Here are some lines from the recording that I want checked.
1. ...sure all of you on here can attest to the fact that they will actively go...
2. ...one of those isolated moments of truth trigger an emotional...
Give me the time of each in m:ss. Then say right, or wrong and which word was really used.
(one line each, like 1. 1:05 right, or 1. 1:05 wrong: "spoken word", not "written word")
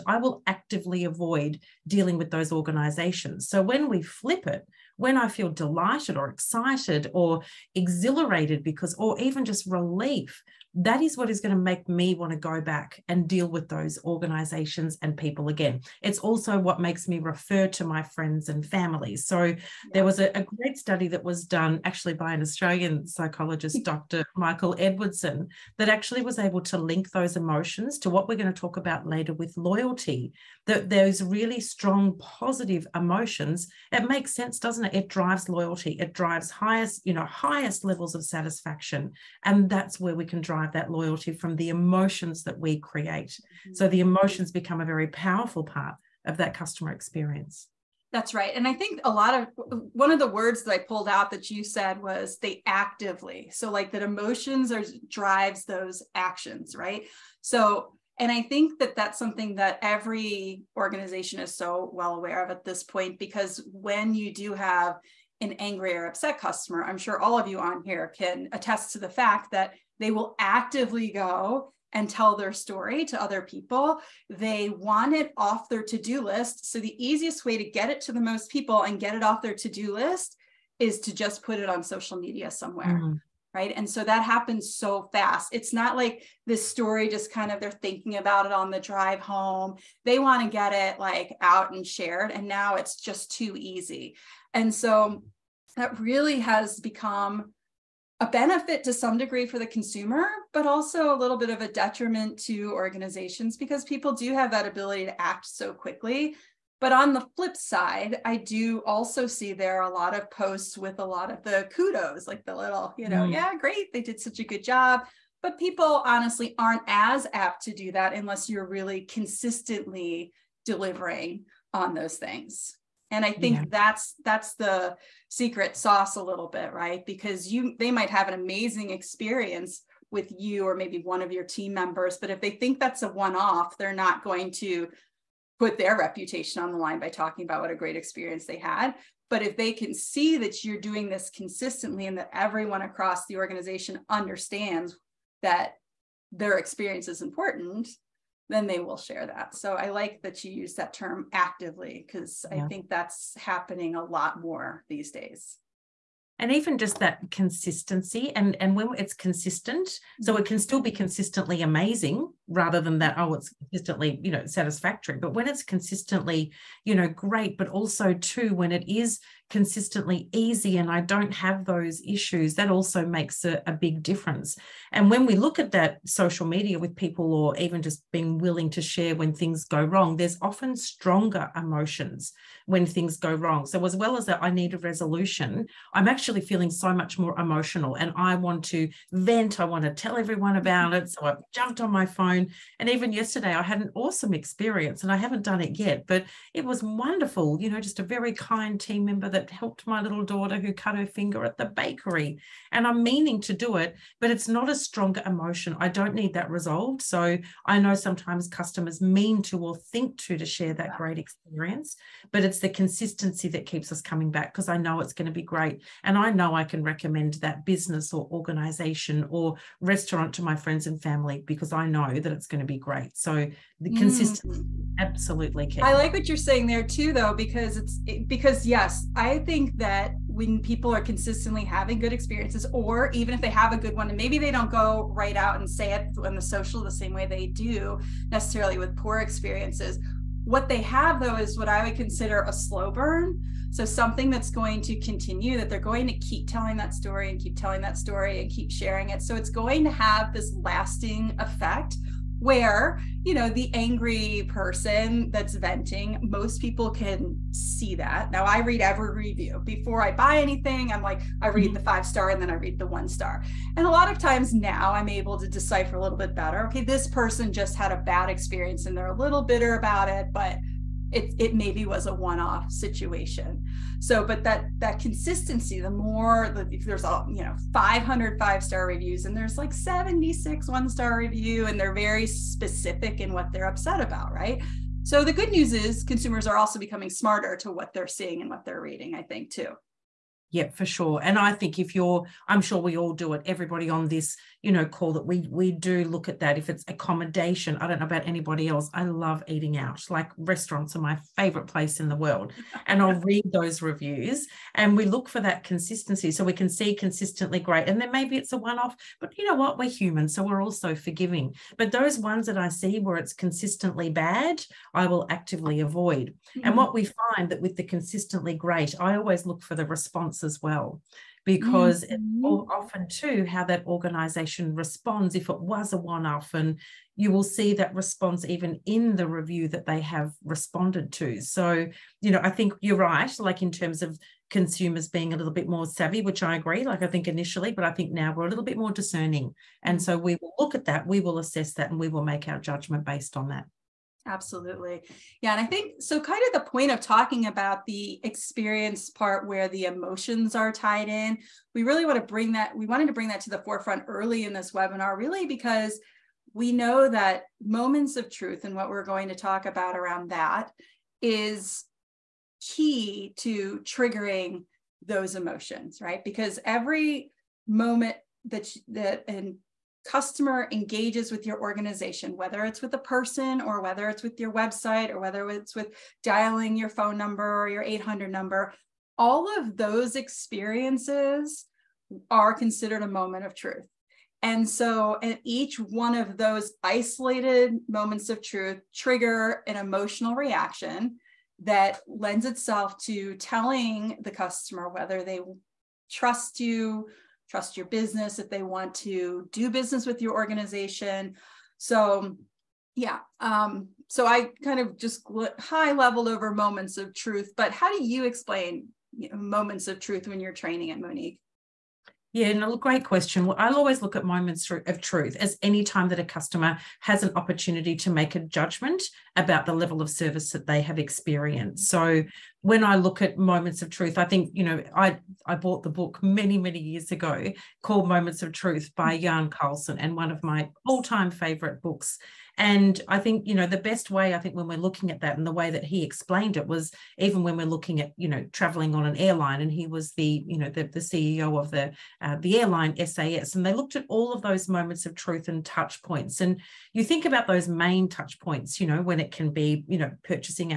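1. 1:06 right
2. 6:25 right.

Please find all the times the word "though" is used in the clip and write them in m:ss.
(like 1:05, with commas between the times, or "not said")
3:47, 4:01.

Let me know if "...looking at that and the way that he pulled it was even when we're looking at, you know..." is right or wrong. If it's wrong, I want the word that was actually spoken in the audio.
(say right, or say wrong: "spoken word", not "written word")
wrong: "explained", not "pulled".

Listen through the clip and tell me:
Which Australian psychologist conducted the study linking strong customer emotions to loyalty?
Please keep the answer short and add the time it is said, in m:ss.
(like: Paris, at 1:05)
Dr. Michael Edwardson, at 0:23.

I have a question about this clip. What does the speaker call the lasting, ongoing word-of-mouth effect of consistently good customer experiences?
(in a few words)
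slow burn.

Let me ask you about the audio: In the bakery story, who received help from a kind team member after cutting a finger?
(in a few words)
my little daughter.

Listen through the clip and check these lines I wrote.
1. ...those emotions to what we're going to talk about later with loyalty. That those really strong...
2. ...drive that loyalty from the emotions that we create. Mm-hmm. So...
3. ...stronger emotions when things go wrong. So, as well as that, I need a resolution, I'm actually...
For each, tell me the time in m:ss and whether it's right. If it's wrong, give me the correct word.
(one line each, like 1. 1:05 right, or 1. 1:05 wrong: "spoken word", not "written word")
1. 0:27 right
2. 0:40 right
3. 3:00 right.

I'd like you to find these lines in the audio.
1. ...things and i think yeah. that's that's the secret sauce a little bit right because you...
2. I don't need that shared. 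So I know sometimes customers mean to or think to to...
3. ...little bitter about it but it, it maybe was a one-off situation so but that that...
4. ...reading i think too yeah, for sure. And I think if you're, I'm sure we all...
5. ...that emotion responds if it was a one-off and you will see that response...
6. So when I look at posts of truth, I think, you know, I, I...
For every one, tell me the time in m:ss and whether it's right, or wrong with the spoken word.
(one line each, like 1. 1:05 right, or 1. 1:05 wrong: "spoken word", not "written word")
1. 2:02 right
2. 3:25 wrong: "resolved", not "shared"
3. 4:29 right
4. 4:48 right
5. 5:23 wrong: "organization", not "emotion"
6. 7:01 wrong: "moments", not "posts".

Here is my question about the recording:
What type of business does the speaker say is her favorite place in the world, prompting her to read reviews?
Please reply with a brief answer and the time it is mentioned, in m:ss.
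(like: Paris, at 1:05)
restaurants, at 5:00.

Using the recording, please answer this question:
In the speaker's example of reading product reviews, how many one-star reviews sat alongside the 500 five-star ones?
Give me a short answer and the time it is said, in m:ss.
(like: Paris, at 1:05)
76, at 4:39.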